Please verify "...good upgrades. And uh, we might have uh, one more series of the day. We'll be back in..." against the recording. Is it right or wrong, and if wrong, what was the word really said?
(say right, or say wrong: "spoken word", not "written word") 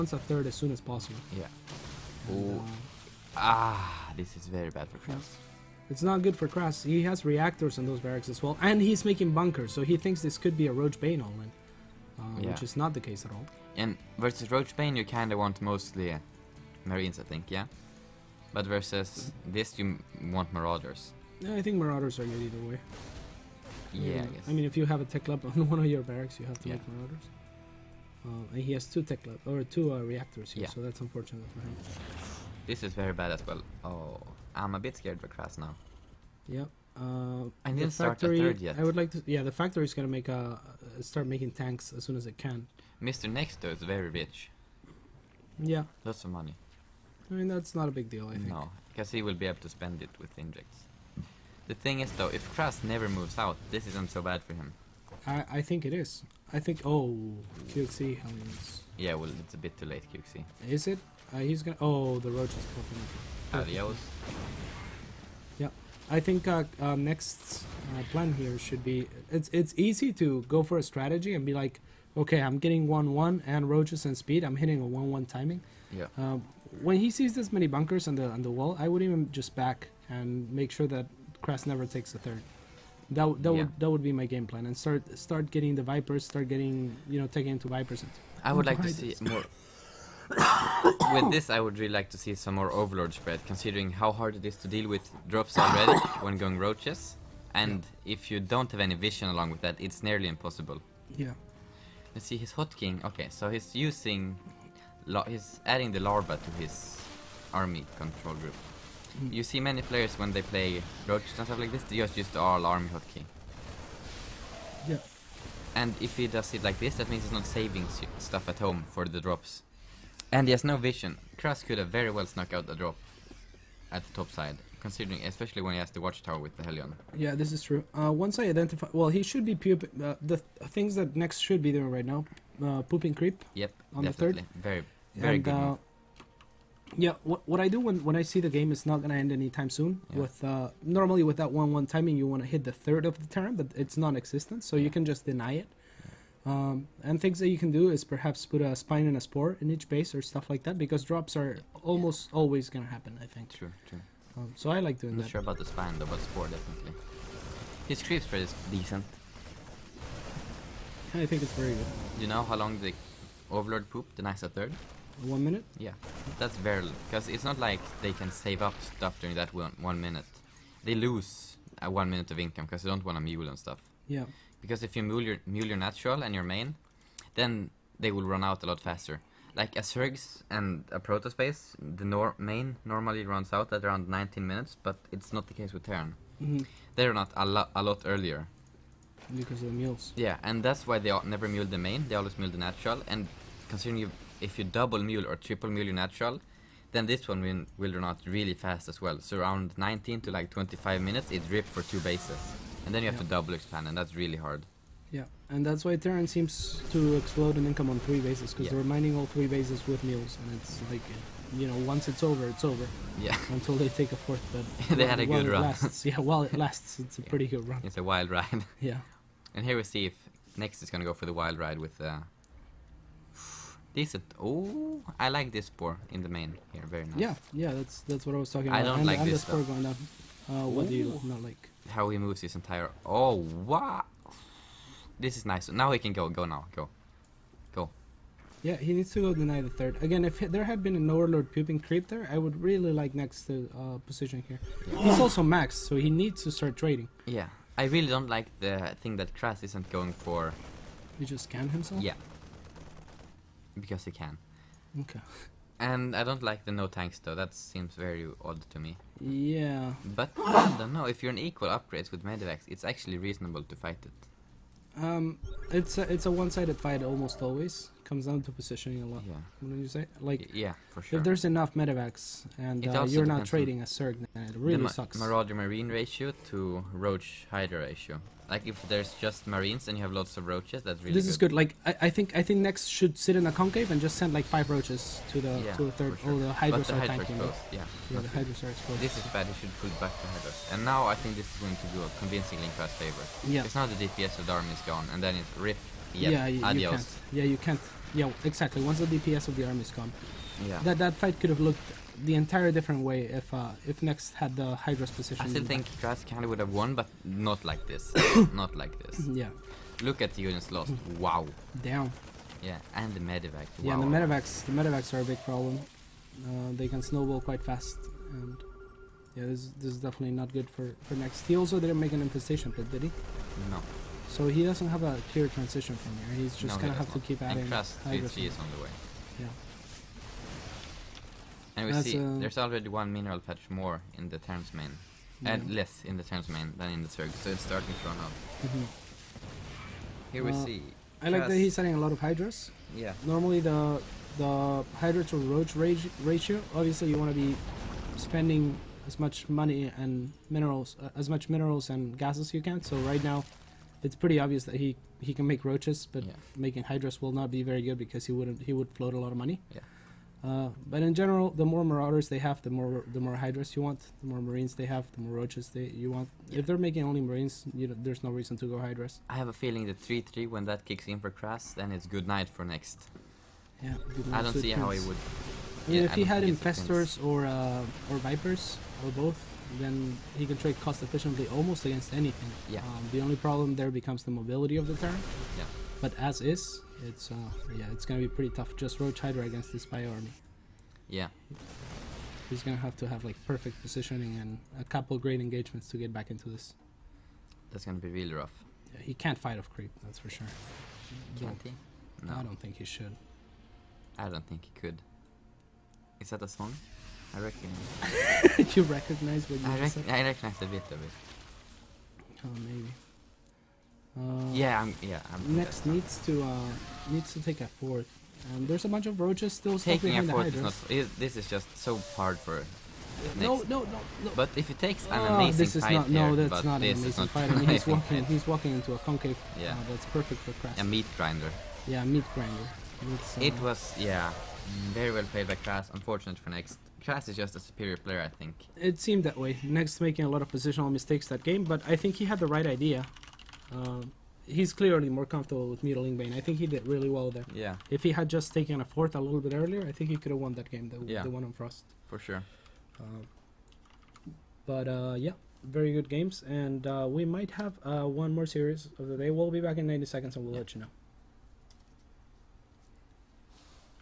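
wrong: "games", not "upgrades".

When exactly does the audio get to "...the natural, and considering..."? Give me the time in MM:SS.
03:12.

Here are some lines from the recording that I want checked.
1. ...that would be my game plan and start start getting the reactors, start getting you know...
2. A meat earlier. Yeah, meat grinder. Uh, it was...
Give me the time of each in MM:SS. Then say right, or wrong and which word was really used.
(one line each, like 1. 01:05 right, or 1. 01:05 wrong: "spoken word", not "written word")
1. 01:23 wrong: "vipers", not "reactors"
2. 07:10 wrong: "grinder", not "earlier".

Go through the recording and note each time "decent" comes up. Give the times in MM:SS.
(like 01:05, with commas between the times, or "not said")
02:38, 03:43.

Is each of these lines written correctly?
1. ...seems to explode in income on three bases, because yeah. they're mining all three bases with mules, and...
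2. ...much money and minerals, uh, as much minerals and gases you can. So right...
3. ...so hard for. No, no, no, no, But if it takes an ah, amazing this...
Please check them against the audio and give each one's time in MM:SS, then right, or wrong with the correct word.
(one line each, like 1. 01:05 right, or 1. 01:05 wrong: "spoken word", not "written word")
1. 03:26 right
2. 05:49 right
3. 07:01 right.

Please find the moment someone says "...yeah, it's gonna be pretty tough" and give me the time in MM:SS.
06:27.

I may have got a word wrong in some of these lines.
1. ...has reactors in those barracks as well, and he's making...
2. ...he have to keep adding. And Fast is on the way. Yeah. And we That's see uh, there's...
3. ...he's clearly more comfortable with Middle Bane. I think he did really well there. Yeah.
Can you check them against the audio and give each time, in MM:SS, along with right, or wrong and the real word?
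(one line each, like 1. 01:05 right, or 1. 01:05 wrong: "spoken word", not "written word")
1. 00:07 right
2. 05:26 right
3. 07:24 right.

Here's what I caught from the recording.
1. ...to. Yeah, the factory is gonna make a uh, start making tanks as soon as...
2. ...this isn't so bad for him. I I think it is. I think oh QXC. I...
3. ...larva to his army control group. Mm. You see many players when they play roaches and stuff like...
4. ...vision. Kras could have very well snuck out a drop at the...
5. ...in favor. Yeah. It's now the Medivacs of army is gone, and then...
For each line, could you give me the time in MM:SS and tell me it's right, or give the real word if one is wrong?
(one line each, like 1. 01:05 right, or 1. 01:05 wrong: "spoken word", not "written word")
1. 00:39 right
2. 00:53 right
3. 01:45 right
4. 02:00 right
5. 04:52 wrong: "DPS", not "Medivacs".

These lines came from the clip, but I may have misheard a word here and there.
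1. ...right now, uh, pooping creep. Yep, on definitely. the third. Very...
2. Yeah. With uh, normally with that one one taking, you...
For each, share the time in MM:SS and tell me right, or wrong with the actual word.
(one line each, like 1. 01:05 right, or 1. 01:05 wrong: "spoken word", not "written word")
1. 02:11 right
2. 02:20 wrong: "timing", not "taking".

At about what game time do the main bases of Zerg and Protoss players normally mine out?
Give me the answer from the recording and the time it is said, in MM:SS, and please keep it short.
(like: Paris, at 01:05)
19 minutes, at 03:04.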